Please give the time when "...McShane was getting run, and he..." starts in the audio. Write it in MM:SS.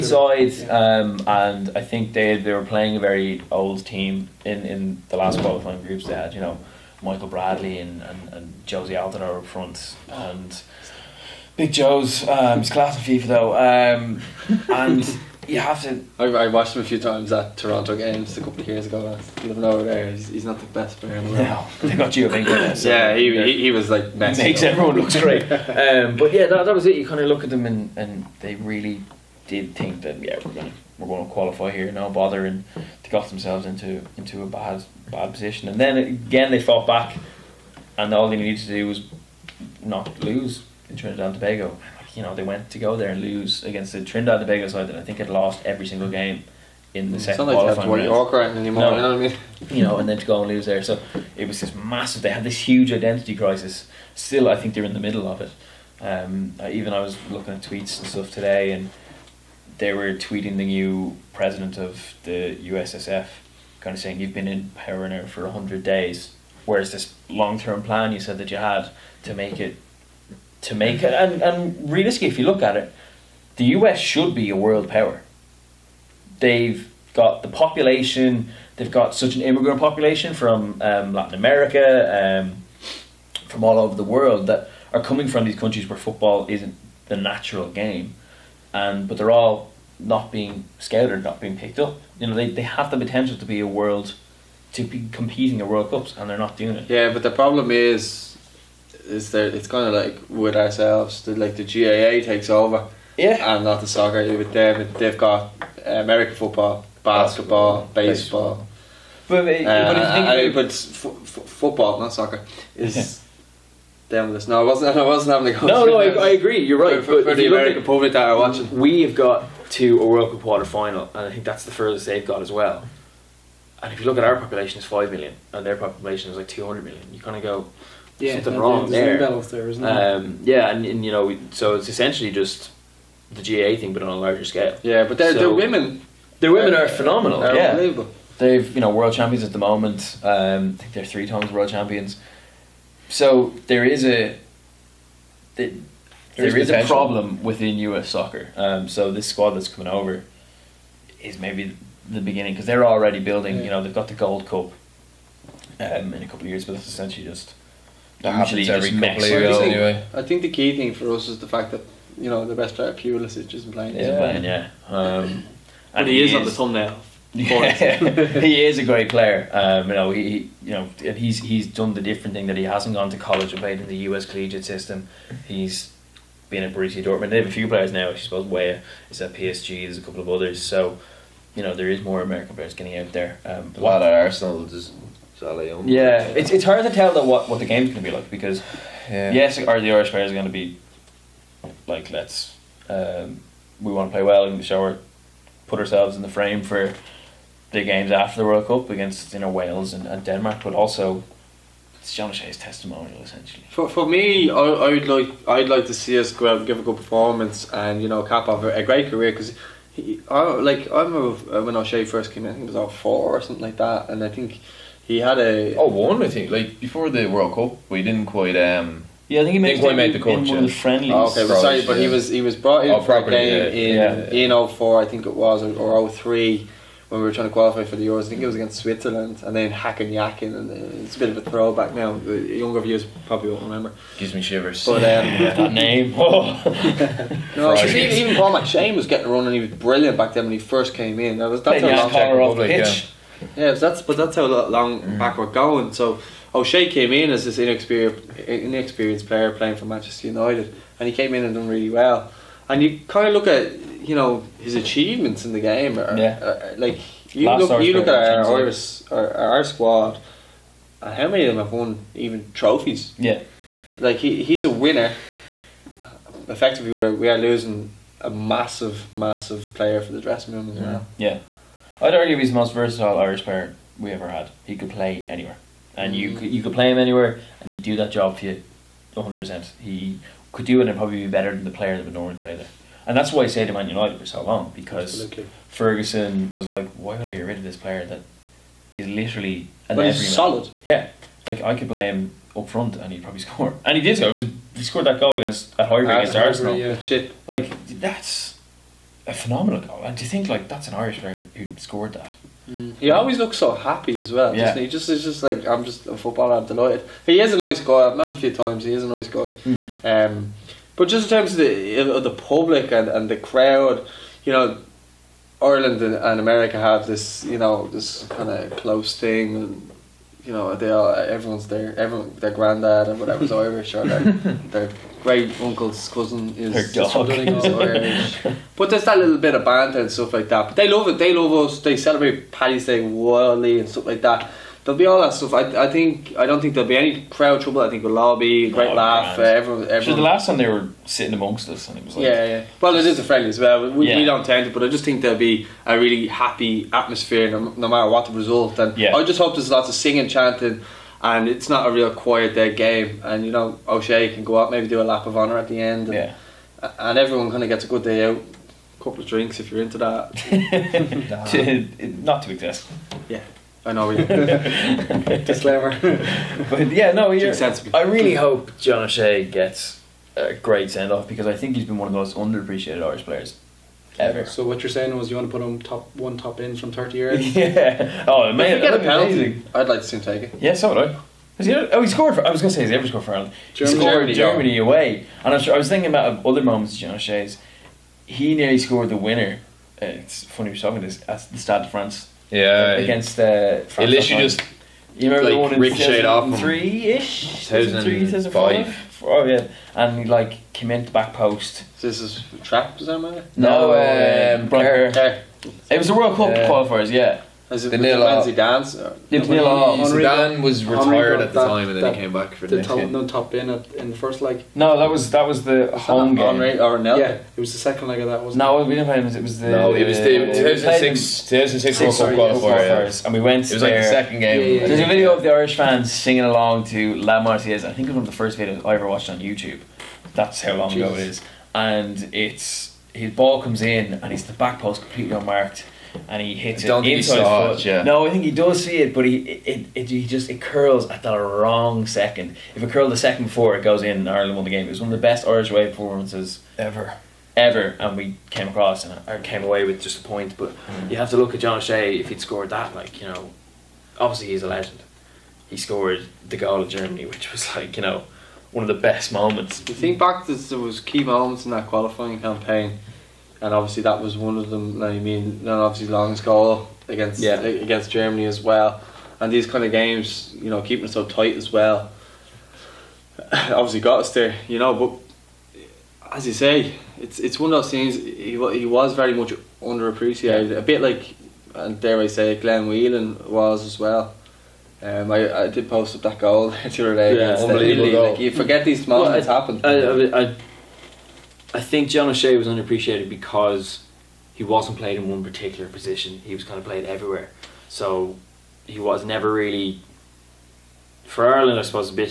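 03:58.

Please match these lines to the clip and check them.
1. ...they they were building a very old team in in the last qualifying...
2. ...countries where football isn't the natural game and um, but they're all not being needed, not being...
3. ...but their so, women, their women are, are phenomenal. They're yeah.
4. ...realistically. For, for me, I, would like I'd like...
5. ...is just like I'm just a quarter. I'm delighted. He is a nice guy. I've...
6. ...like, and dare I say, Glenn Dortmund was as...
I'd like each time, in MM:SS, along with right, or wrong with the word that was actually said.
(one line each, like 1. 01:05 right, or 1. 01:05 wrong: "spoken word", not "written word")
1. 00:02 wrong: "playing", not "building"
2. 01:25 wrong: "scouted", not "needed"
3. 02:15 right
4. 03:23 wrong: "essentially", not "realistically"
5. 05:05 wrong: "footballer", not "quarter"
6. 08:01 wrong: "Whelan", not "Dortmund".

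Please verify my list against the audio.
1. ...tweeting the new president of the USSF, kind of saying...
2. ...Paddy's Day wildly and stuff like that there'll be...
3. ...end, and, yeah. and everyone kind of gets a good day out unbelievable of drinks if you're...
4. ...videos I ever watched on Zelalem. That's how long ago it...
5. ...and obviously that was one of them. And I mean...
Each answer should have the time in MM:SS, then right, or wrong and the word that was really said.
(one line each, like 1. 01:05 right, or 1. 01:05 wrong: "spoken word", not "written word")
1. 01:00 right
2. 05:32 right
3. 05:55 wrong: "couple", not "unbelievable"
4. 07:08 wrong: "YouTube", not "Zelalem"
5. 07:43 right.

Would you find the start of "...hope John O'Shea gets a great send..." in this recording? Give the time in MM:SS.
06:08.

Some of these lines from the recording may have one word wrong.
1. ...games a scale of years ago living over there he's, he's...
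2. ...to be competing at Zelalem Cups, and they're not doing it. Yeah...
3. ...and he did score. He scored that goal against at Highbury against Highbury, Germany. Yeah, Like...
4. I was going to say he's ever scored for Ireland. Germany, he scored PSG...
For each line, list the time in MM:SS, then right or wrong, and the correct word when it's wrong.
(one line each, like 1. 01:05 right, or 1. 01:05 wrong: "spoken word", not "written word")
1. 00:17 wrong: "couple", not "scale"
2. 01:34 wrong: "World", not "Zelalem"
3. 04:53 wrong: "Arsenal", not "Germany"
4. 06:22 wrong: "Germany", not "PSG".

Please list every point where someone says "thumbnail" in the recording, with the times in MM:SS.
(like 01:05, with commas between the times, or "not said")
02:46.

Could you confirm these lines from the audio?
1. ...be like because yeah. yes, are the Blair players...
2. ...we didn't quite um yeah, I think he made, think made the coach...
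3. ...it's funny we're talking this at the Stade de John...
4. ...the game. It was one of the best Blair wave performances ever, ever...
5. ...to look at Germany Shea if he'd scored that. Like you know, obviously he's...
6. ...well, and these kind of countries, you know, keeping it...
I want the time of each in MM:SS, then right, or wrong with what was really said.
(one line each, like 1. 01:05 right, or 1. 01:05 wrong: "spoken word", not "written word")
1. 03:08 wrong: "Irish", not "Blair"
2. 03:37 right
3. 06:30 wrong: "France", not "John"
4. 07:24 wrong: "Irish", not "Blair"
5. 07:31 wrong: "John", not "Germany"
6. 07:48 wrong: "games", not "countries".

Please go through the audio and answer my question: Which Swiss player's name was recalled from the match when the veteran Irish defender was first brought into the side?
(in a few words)
Hakan Yakin.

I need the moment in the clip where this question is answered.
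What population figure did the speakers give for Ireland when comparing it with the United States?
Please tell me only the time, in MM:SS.
02:04.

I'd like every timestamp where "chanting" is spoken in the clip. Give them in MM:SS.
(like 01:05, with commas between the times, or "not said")
05:50.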